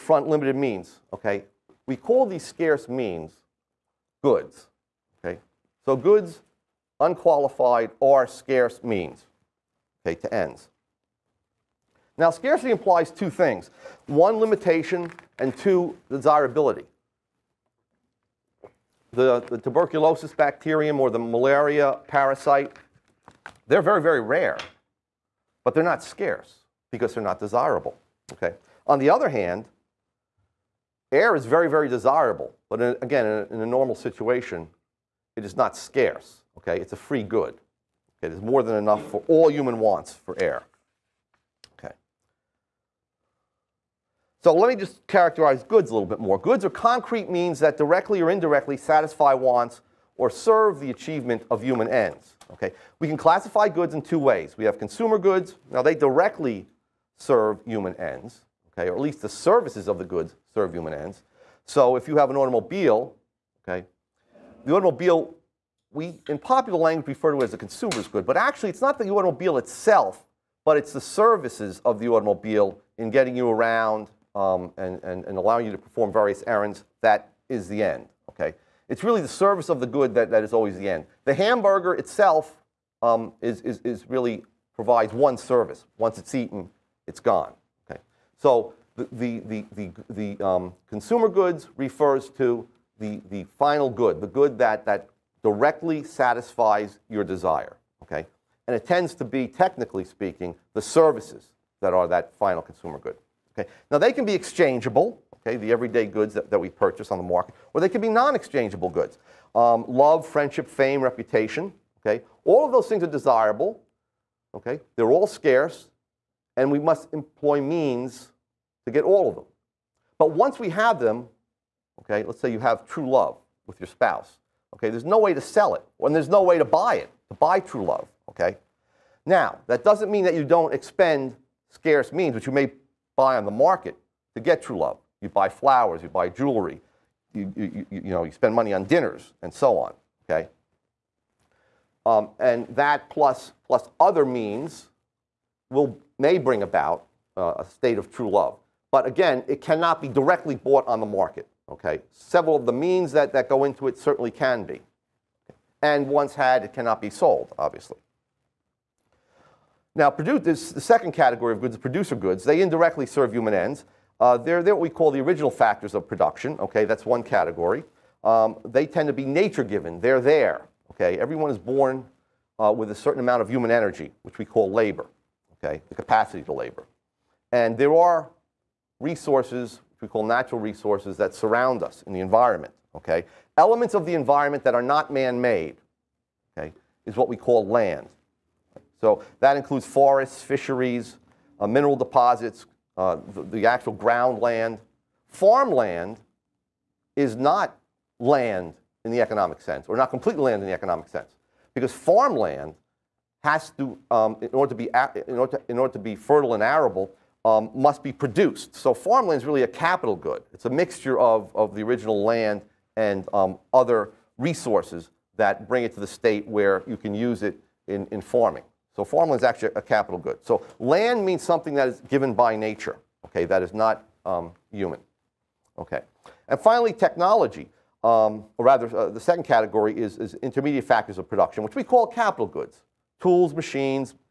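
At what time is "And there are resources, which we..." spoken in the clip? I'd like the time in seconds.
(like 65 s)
177 s.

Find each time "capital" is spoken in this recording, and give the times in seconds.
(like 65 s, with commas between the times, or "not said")
209 s, 219 s, 232 s.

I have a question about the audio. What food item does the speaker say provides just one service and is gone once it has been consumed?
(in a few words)
Hamburger.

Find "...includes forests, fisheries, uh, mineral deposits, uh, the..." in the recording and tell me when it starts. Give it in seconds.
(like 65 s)
189 s.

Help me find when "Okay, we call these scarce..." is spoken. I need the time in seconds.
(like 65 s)
1 s.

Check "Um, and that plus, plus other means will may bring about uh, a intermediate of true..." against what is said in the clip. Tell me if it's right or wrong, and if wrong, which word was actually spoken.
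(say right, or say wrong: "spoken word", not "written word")
wrong: "state", not "intermediate".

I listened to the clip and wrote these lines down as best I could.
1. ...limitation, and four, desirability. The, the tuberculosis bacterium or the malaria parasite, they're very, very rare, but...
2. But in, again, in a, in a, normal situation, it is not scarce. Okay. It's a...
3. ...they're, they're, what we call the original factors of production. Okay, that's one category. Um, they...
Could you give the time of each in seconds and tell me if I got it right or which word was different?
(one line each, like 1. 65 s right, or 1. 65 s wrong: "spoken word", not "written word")
1. 14 s wrong: "two", not "four"
2. 32 s right
3. 164 s right.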